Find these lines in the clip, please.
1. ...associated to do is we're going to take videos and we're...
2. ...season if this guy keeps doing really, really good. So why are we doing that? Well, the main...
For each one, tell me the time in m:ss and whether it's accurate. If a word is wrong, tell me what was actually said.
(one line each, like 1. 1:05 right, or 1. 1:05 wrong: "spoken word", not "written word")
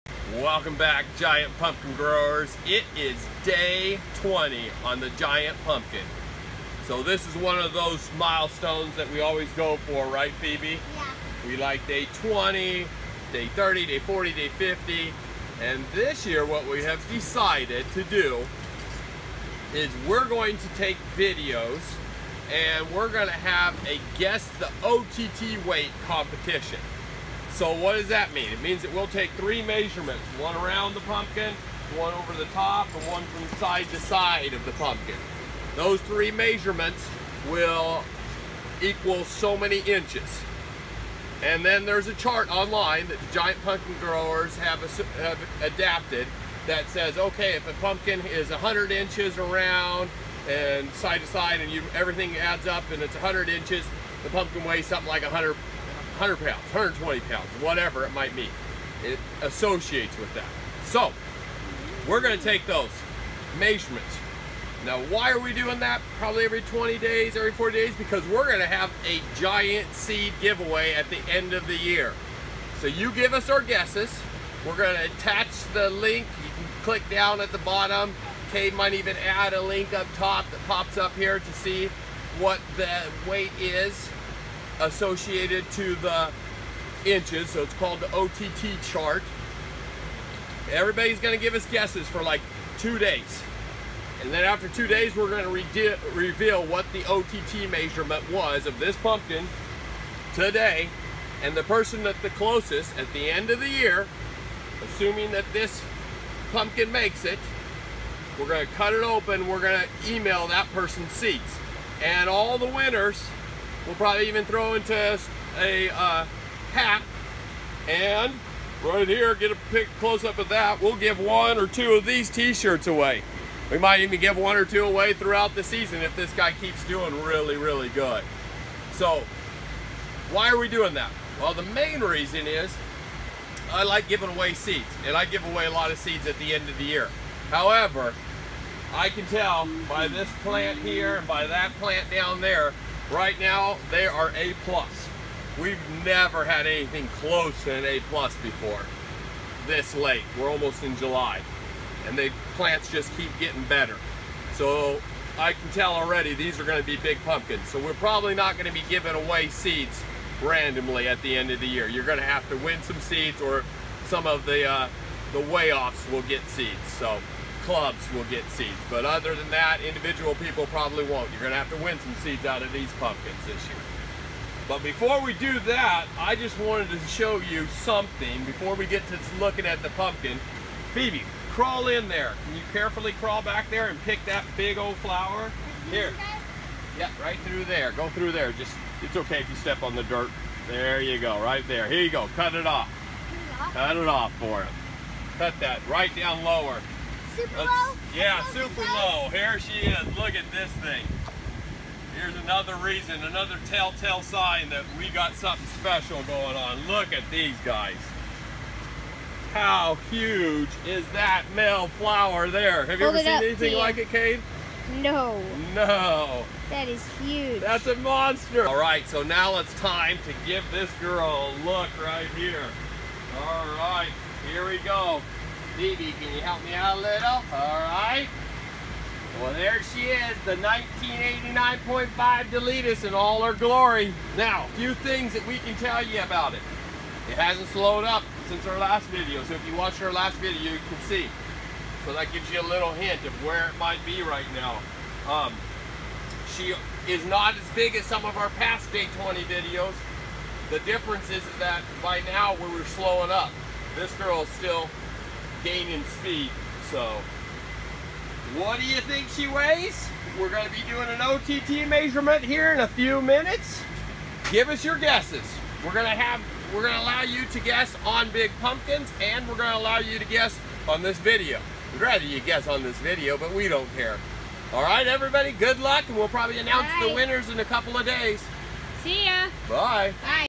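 1. 0:17 wrong: "decided", not "associated"
2. 2:05 right.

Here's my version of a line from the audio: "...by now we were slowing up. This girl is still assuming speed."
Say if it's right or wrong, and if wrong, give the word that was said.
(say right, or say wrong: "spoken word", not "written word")
wrong: "gaining", not "assuming".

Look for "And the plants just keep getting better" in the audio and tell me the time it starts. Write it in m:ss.
2:32.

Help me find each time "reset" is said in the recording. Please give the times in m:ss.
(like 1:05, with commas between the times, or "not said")
not said.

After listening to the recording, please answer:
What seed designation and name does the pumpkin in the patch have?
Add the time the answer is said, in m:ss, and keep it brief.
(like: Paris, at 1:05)
1989.5 Deletus, at 3:50.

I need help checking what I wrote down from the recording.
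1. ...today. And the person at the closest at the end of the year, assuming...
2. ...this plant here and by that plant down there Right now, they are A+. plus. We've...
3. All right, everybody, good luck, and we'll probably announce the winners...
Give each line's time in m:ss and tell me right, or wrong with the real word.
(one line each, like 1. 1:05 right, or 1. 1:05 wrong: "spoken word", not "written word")
1. 1:40 right
2. 2:20 right
3. 4:34 right.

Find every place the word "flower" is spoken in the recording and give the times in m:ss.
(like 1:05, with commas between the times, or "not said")
3:04, 3:31.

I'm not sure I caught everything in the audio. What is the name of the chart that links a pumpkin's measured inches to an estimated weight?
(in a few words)
OTT chart.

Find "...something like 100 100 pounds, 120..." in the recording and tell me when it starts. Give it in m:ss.
0:54.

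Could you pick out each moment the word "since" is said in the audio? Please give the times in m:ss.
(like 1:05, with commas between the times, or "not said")
3:58.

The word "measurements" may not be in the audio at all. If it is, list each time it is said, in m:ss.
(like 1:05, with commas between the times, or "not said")
0:29, 0:36, 1:03, 1:37, 4:21.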